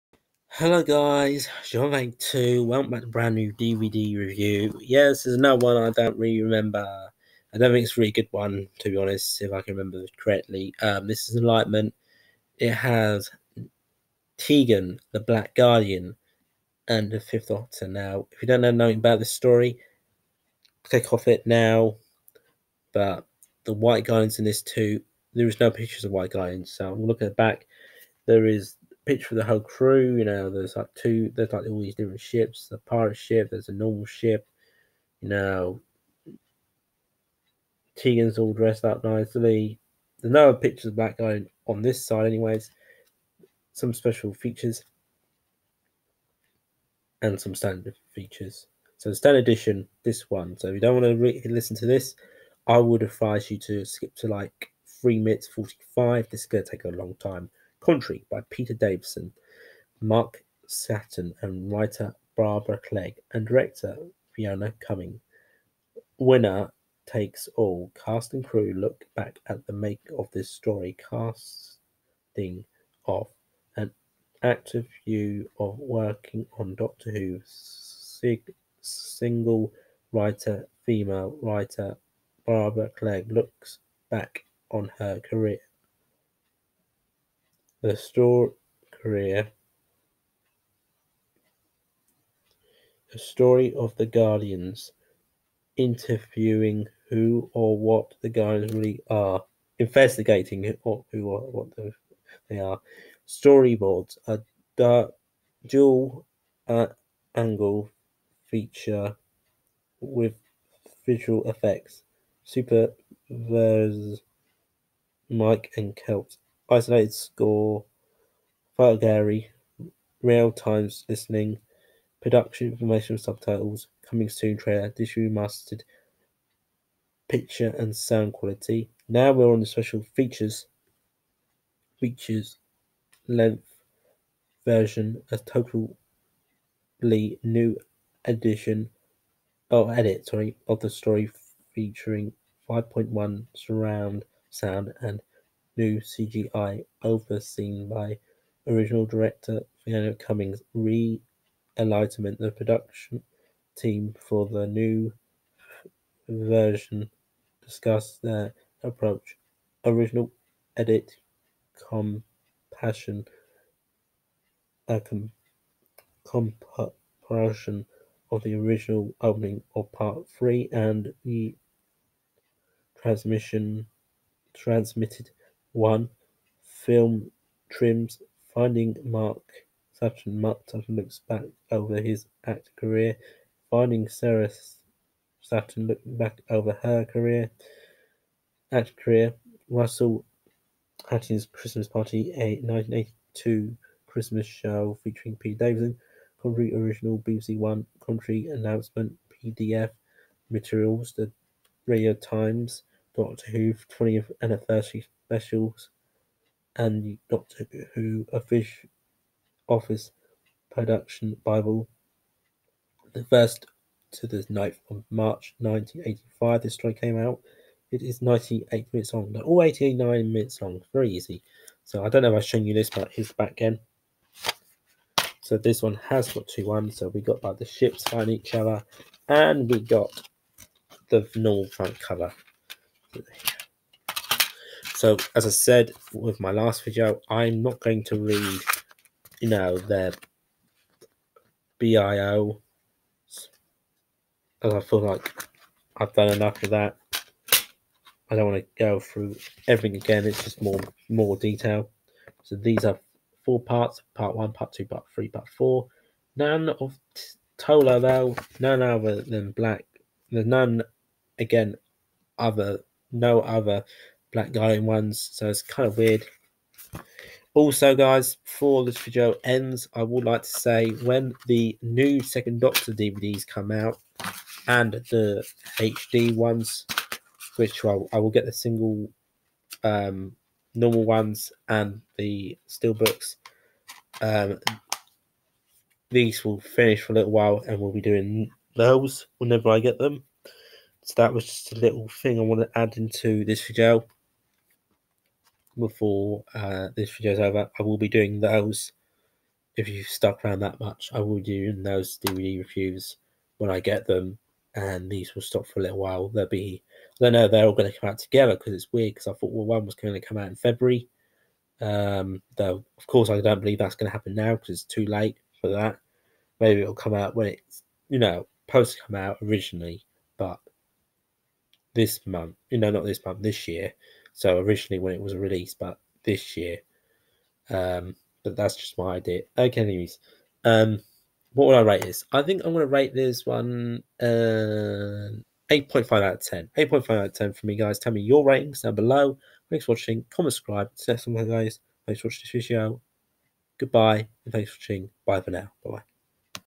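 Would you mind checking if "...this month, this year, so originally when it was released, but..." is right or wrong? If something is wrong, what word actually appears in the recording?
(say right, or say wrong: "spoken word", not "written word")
right.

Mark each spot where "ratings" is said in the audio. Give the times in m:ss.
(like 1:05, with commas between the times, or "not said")
5:38.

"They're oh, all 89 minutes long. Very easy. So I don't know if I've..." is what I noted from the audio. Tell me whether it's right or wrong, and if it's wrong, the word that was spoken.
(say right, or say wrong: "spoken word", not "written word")
right.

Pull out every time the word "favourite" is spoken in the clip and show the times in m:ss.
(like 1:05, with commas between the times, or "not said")
not said.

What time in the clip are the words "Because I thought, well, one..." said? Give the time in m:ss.
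5:09.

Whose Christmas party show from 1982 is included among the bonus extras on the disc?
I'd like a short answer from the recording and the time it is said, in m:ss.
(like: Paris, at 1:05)
Russell Harty, at 3:09.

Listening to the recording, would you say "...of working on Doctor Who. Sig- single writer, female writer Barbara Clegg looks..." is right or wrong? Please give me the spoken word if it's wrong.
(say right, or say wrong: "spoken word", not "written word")
right.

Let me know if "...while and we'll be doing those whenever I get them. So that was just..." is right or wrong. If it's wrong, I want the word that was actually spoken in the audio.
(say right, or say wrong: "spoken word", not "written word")
right.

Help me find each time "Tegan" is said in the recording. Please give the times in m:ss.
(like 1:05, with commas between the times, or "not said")
0:14, 0:37.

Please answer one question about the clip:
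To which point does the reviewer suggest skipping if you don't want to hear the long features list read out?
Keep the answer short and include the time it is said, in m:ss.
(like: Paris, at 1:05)
3:45, at 0:54.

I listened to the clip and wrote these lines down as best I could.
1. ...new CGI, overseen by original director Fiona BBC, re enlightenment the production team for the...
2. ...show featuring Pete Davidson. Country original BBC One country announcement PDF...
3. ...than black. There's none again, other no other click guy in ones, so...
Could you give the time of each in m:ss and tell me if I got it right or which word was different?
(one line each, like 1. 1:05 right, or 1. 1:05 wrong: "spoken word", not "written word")
1. 2:25 wrong: "Cummings", not "BBC"
2. 3:14 right
3. 4:19 wrong: "black", not "click".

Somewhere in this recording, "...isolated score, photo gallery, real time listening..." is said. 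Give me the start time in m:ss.
1:56.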